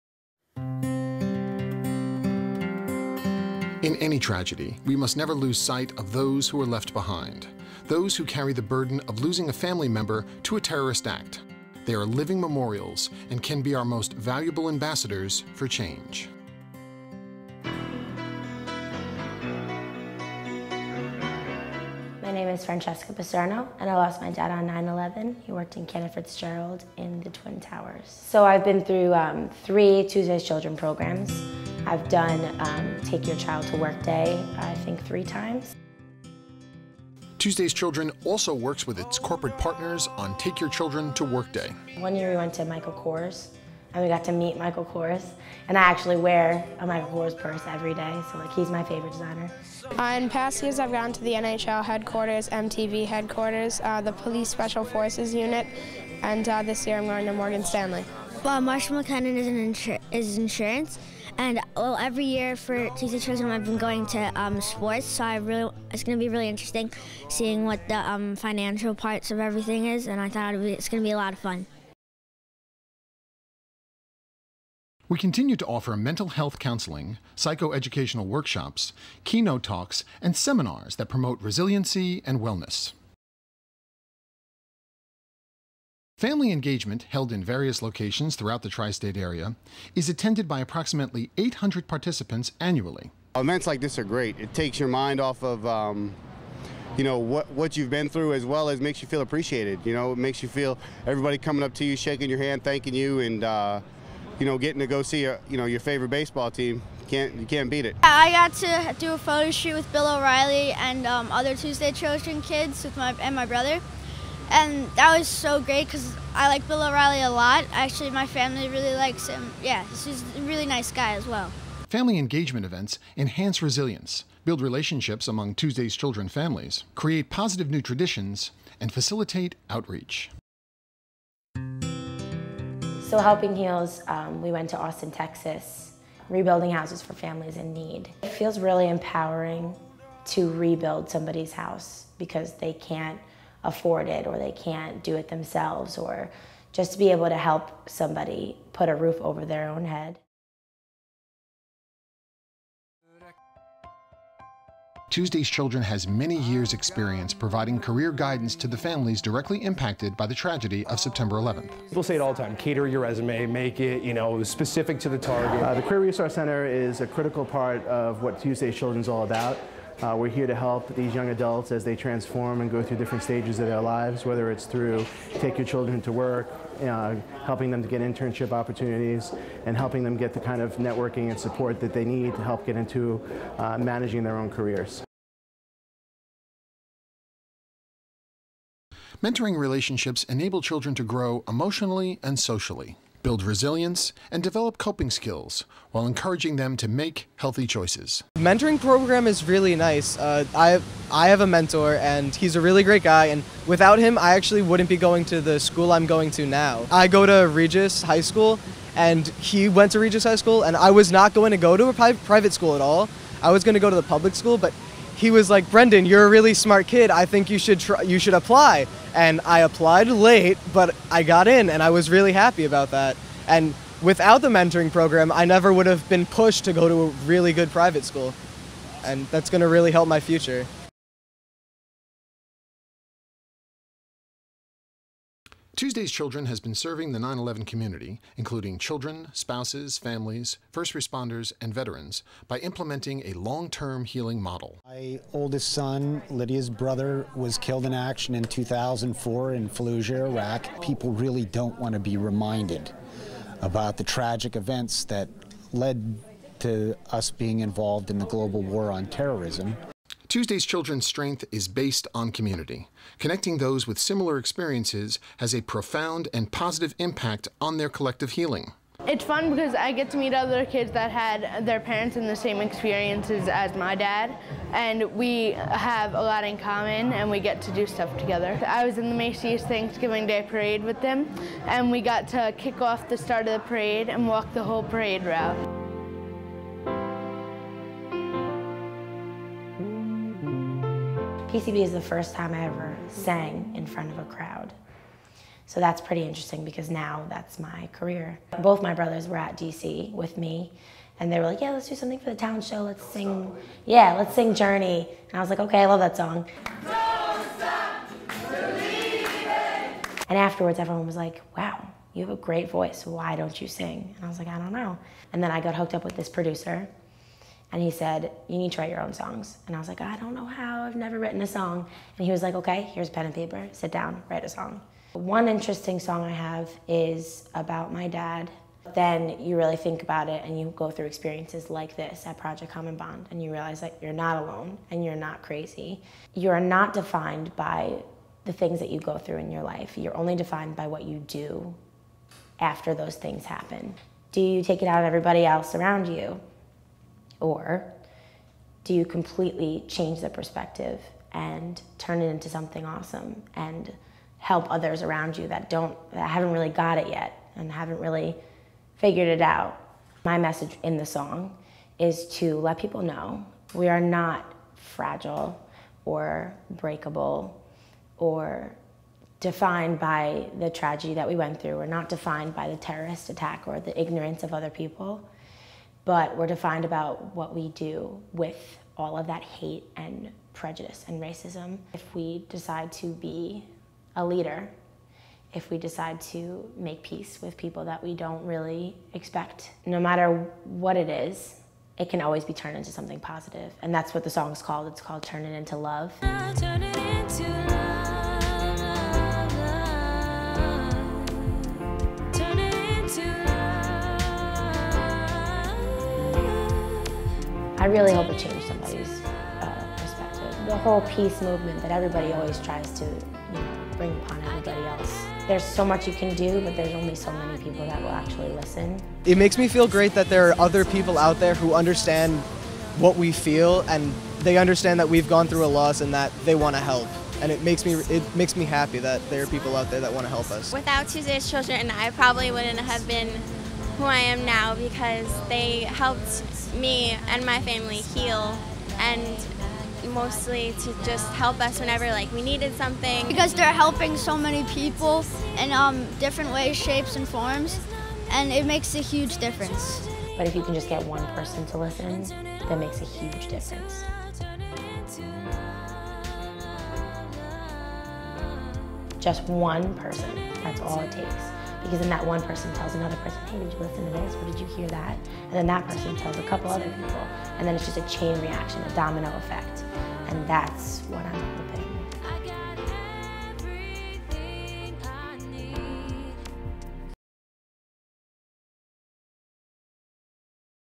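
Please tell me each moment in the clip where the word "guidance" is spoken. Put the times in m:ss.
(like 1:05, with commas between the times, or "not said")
2:38.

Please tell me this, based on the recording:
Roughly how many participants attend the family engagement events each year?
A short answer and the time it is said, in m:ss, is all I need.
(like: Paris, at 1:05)
800, at 1:31.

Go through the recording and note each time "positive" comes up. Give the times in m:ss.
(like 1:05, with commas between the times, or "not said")
2:07, 4:26, 6:33.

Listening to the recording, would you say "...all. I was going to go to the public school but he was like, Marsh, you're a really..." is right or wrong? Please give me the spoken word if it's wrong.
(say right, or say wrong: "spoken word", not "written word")
wrong: "Brendan", not "Marsh".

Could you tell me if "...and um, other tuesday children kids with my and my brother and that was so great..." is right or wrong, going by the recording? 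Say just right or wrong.
right.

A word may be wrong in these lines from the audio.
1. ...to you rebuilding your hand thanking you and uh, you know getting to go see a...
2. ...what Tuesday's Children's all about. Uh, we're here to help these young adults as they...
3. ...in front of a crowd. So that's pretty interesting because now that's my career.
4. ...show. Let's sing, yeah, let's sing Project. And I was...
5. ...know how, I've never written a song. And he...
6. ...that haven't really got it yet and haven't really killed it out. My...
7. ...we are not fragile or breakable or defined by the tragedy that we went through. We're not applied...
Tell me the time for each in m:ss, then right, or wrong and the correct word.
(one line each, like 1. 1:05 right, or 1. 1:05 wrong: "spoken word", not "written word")
1. 1:41 wrong: "shaking", not "rebuilding"
2. 2:48 right
3. 4:53 right
4. 5:02 wrong: "Journey", not "Project"
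5. 5:20 right
6. 5:56 wrong: "figured", not "killed"
7. 6:03 wrong: "defined", not "applied".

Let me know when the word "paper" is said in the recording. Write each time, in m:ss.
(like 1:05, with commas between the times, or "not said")
5:23.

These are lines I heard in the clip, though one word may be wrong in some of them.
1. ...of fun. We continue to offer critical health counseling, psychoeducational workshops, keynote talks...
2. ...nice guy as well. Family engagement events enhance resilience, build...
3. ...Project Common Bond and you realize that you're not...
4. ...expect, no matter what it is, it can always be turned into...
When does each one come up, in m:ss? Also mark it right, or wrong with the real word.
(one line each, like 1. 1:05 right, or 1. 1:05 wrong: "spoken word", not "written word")
1. 1:11 wrong: "mental", not "critical"
2. 2:00 right
3. 5:32 right
4. 6:29 right.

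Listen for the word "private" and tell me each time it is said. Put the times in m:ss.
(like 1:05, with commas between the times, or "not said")
3:32, 3:47.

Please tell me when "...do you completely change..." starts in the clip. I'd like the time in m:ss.
5:48.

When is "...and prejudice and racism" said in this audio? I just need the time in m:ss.
6:19.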